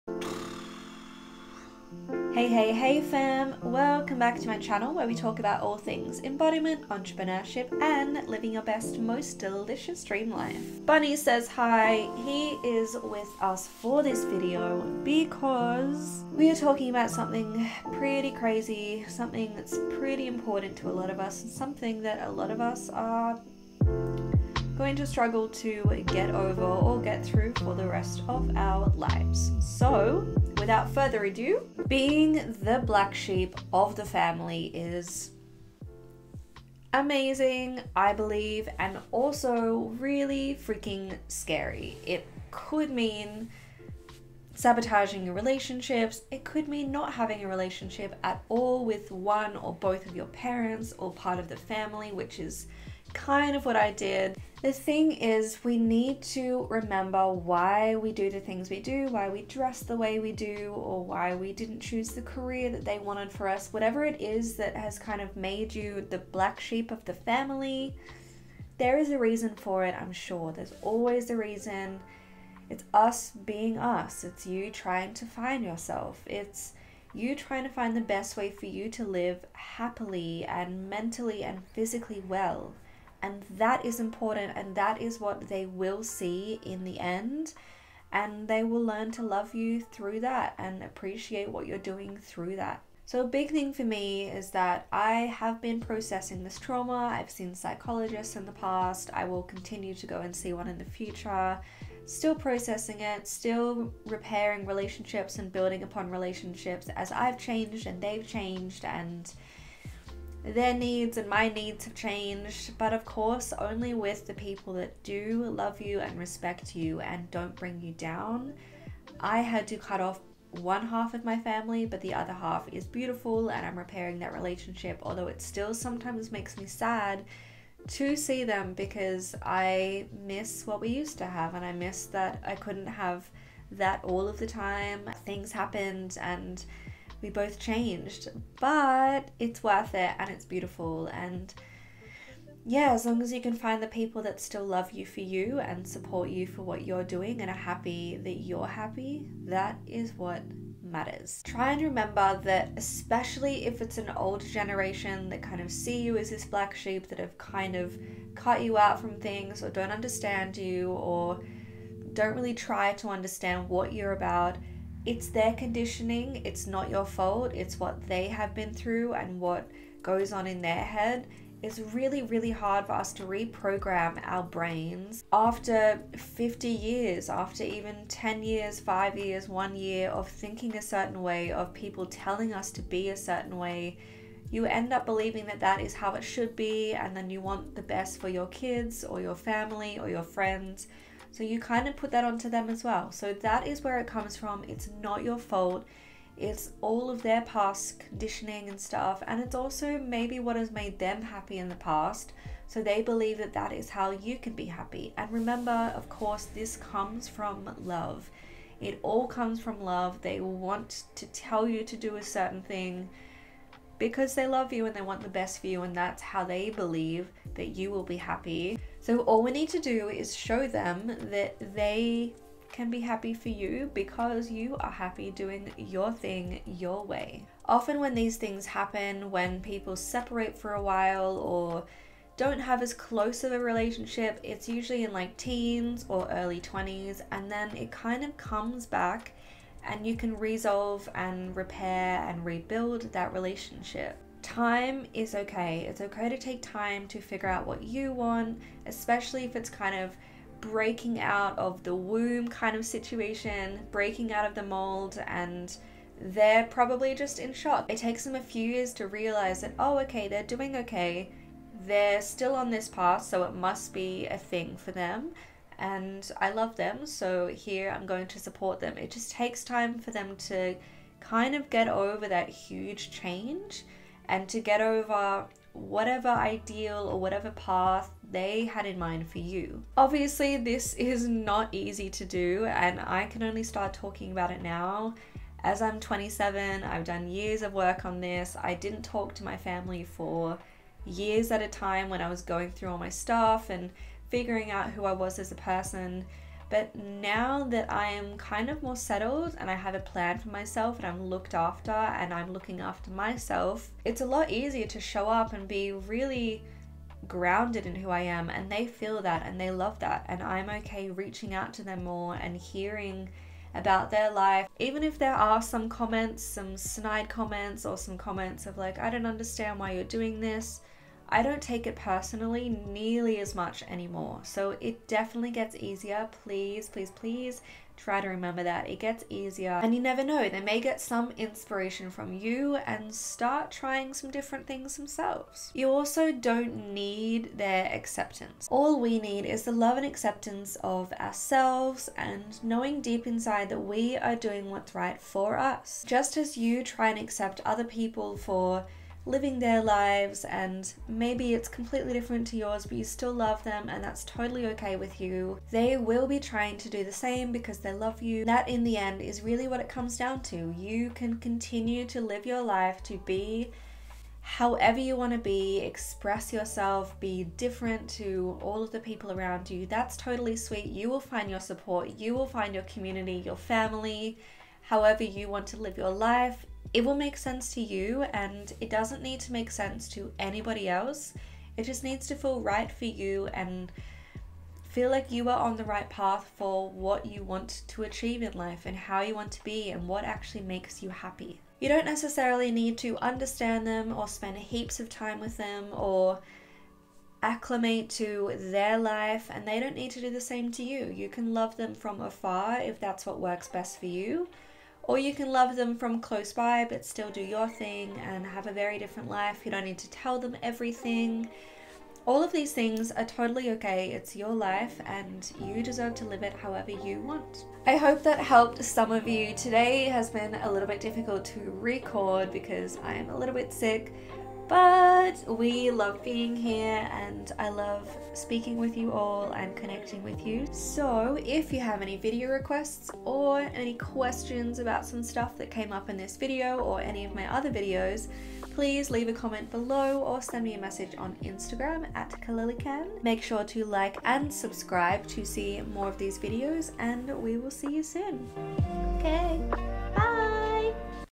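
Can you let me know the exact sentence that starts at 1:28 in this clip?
And they will learn to love you through that and appreciate what you're doing through that.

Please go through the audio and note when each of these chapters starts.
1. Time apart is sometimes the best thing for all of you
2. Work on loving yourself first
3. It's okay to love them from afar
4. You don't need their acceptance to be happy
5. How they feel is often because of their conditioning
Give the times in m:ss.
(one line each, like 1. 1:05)
1. 3:49
2. 4:40
3. 6:32
4. 5:37
5. 1:34.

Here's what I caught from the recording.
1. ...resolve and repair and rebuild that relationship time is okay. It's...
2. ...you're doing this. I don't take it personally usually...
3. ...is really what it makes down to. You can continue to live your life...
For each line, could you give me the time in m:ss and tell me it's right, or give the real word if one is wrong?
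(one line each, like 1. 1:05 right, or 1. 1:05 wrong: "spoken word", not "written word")
1. 4:00 right
2. 5:19 wrong: "nearly", not "usually"
3. 5:59 wrong: "comes", not "makes".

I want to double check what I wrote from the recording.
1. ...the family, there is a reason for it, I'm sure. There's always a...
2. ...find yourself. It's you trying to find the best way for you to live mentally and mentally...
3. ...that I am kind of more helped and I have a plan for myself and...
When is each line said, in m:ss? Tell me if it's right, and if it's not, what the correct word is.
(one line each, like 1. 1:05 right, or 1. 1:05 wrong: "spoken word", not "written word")
1. 1:07 right
2. 1:15 wrong: "happily", not "mentally"
3. 4:57 wrong: "settled", not "helped".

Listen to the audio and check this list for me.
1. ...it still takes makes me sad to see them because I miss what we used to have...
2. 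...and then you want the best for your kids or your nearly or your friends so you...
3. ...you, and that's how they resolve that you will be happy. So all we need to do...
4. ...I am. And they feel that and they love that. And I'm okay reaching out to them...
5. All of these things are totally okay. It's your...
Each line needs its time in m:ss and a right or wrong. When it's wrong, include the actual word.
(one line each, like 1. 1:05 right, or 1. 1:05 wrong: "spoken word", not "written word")
1. 2:05 wrong: "sometimes", not "takes"
2. 3:06 wrong: "family", not "nearly"
3. 3:35 wrong: "believe", not "resolve"
4. 5:08 right
5. 6:52 right.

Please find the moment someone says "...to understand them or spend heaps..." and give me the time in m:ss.
6:32.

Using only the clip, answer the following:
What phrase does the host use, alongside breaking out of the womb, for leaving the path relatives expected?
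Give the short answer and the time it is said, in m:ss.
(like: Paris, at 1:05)
Breaking out of the mold, at 4:13.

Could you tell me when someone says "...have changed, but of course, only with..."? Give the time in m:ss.
1:51.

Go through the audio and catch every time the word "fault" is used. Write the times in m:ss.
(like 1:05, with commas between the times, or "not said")
2:47, 3:15.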